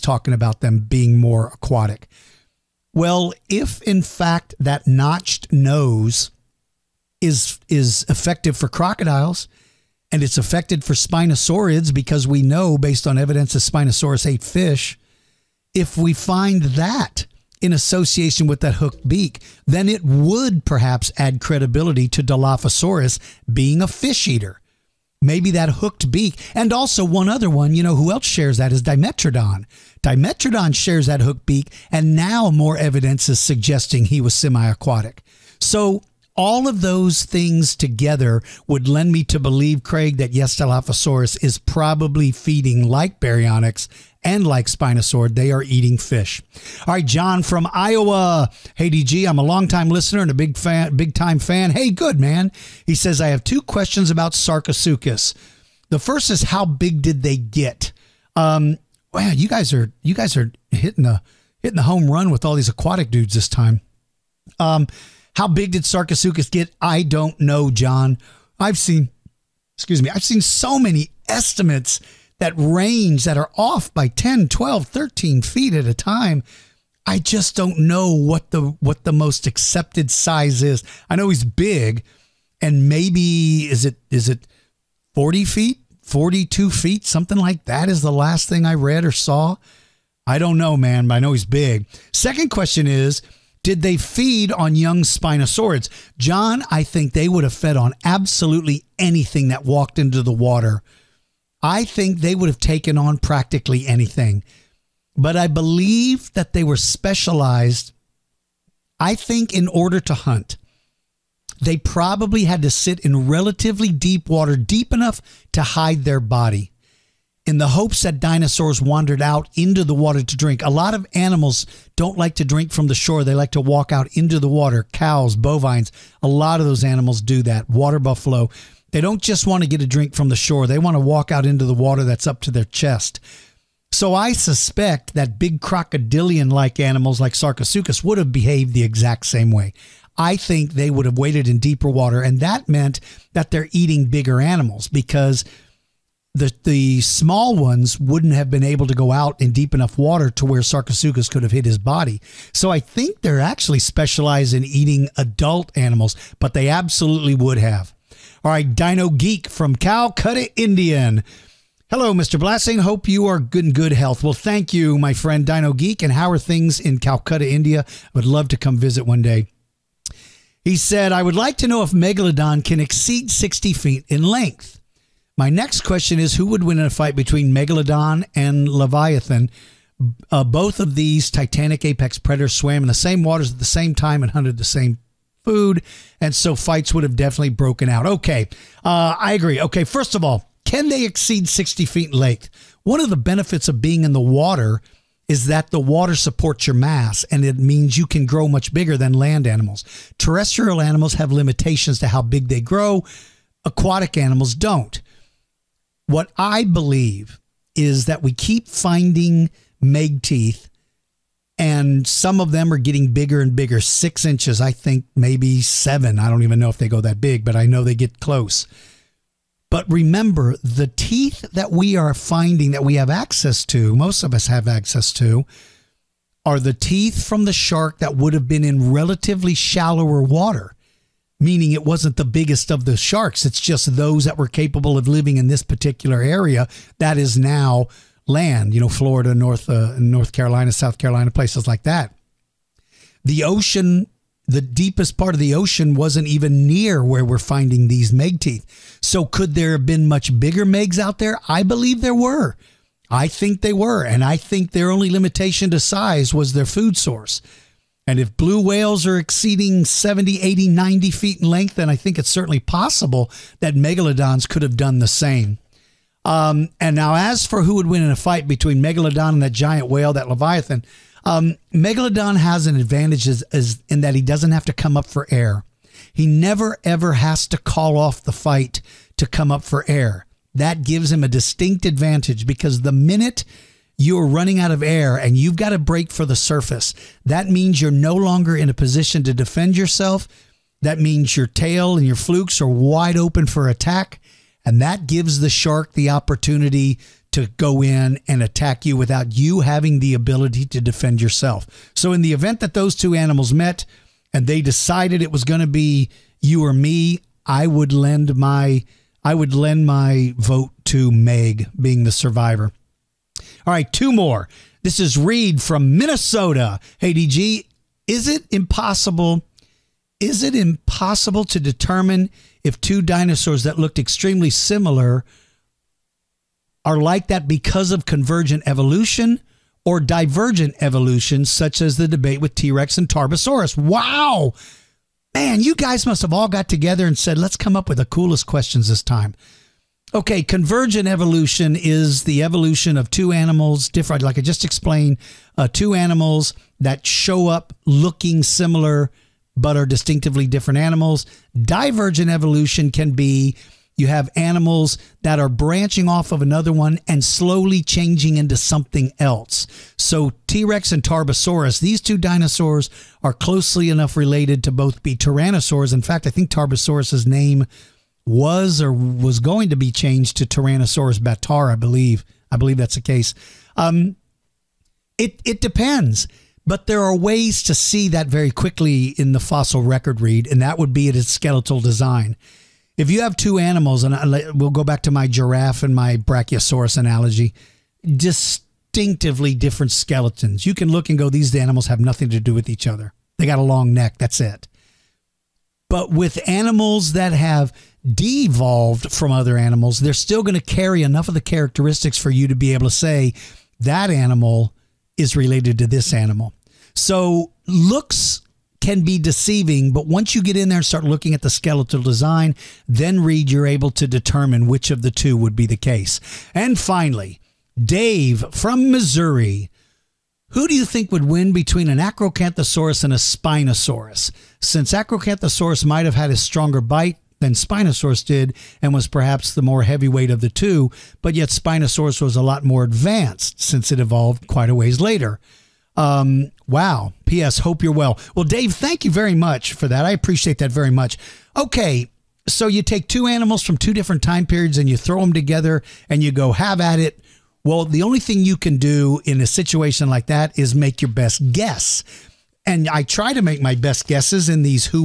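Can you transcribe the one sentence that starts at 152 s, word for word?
So I think they're actually specialized in eating adult animals, but they absolutely would have.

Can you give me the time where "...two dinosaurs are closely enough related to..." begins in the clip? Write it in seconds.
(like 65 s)
362 s.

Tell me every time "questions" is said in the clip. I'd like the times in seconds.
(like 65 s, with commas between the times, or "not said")
53 s, 92 s, 175 s, 338 s.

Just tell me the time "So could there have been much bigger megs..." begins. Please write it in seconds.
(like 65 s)
249 s.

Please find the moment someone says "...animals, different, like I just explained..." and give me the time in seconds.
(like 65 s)
343 s.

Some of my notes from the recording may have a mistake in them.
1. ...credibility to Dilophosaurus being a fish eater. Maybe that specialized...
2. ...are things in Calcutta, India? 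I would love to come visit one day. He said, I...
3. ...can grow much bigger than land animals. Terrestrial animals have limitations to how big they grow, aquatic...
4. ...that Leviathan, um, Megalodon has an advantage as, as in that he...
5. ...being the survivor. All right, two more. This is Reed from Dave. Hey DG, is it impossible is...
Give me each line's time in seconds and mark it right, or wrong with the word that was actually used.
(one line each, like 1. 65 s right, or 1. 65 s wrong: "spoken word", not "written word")
1. 21 s wrong: "hooked", not "specialized"
2. 166 s right
3. 198 s right
4. 270 s right
5. 311 s wrong: "Minnesota", not "Dave".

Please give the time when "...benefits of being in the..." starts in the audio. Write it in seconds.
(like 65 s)
193 s.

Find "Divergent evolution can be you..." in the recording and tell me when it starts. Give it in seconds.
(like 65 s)
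351 s.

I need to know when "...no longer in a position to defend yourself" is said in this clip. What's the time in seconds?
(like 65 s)
287 s.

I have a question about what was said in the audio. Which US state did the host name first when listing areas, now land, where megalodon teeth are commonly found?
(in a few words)
Florida.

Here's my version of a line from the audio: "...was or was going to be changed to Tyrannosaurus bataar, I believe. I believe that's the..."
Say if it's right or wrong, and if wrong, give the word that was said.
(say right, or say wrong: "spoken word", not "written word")
right.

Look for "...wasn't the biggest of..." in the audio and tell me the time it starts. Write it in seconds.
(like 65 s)
231 s.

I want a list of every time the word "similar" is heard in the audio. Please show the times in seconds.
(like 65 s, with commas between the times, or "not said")
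324 s, 348 s.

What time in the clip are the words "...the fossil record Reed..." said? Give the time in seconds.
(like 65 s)
379 s.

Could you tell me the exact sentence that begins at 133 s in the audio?
So I suspect that big crocodilian like animals like Sarcosuchus would have behaved the exact same way.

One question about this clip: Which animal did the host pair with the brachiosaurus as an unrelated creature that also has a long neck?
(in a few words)
giraffe.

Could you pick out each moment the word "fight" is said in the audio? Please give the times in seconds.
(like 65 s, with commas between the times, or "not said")
176 s, 186 s, 268 s, 278 s.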